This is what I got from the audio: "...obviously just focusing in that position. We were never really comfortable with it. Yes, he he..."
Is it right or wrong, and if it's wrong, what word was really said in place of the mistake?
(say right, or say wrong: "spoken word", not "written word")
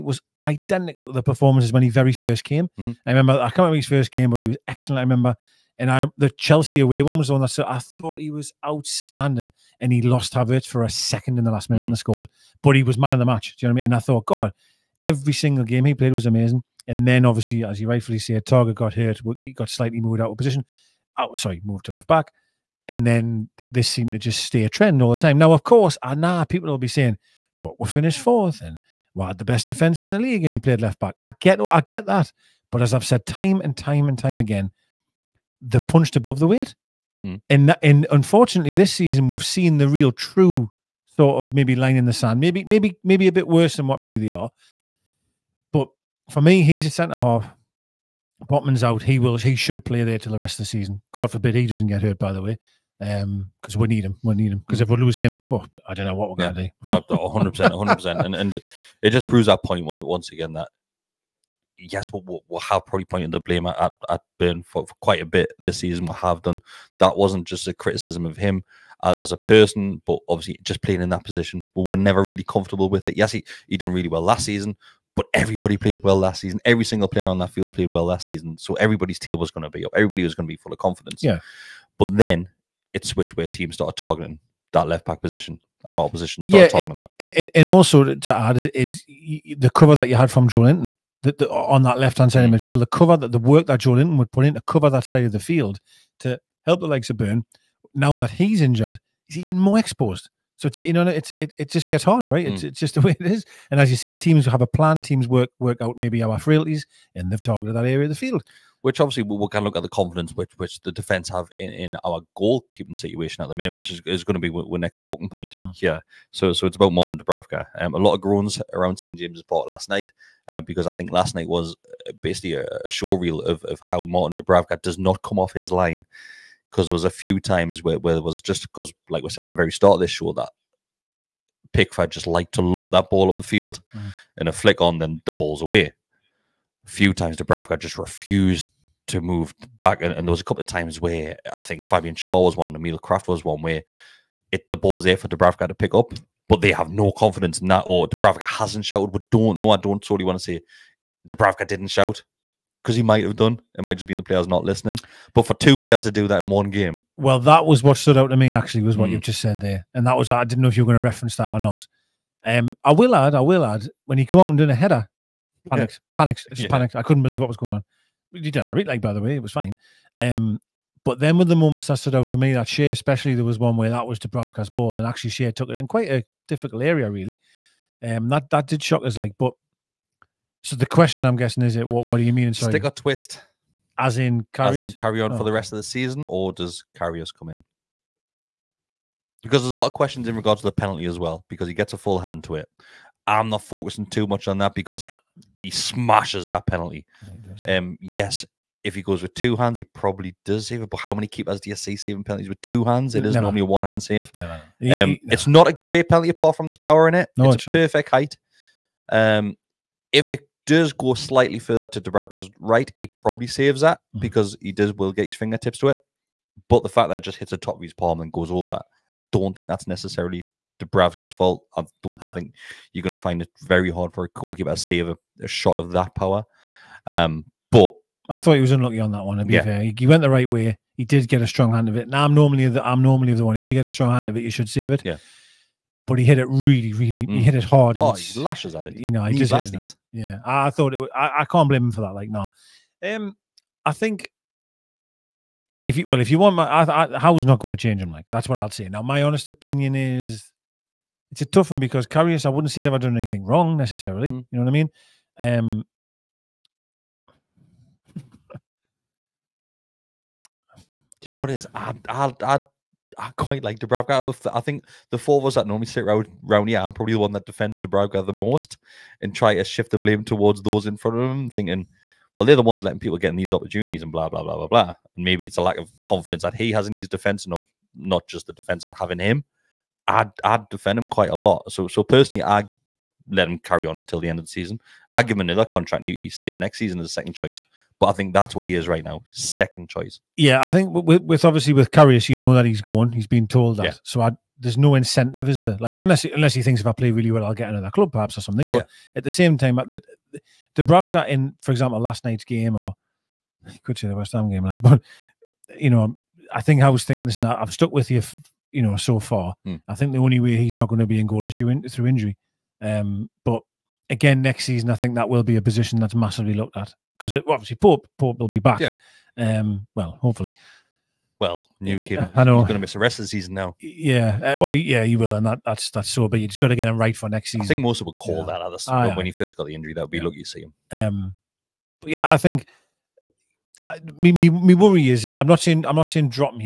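wrong: "playing", not "focusing".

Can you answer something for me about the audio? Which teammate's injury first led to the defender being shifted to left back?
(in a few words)
Targett.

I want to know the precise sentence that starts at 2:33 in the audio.
It might just be in the players not listening.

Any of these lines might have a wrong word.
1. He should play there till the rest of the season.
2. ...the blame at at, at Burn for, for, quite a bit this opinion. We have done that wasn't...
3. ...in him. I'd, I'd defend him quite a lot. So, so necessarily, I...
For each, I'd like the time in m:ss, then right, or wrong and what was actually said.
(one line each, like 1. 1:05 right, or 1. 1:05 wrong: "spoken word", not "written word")
1. 0:49 right
2. 1:03 wrong: "season", not "opinion"
3. 4:39 wrong: "personally", not "necessarily".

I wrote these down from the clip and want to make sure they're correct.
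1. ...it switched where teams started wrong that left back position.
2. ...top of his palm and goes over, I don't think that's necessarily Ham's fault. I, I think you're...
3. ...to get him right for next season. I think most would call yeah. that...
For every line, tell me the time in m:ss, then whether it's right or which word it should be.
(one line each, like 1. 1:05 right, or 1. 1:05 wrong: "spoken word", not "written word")
1. 1:22 wrong: "targeting", not "wrong"
2. 3:37 wrong: "Dubravka", not "Ham"
3. 5:26 right.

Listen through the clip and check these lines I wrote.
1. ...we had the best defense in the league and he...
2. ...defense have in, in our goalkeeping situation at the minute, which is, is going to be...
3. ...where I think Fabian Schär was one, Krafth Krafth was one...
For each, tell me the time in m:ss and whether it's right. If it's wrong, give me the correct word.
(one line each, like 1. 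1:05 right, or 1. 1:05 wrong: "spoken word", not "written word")
1. 0:29 right
2. 1:50 right
3. 2:20 wrong: "Emil", not "Krafth".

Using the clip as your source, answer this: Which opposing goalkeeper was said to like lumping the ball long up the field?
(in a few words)
Pickford.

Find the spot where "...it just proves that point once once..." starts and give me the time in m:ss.
0:59.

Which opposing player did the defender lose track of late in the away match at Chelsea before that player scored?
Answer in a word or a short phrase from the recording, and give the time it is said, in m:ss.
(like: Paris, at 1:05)
Havertz, at 0:10.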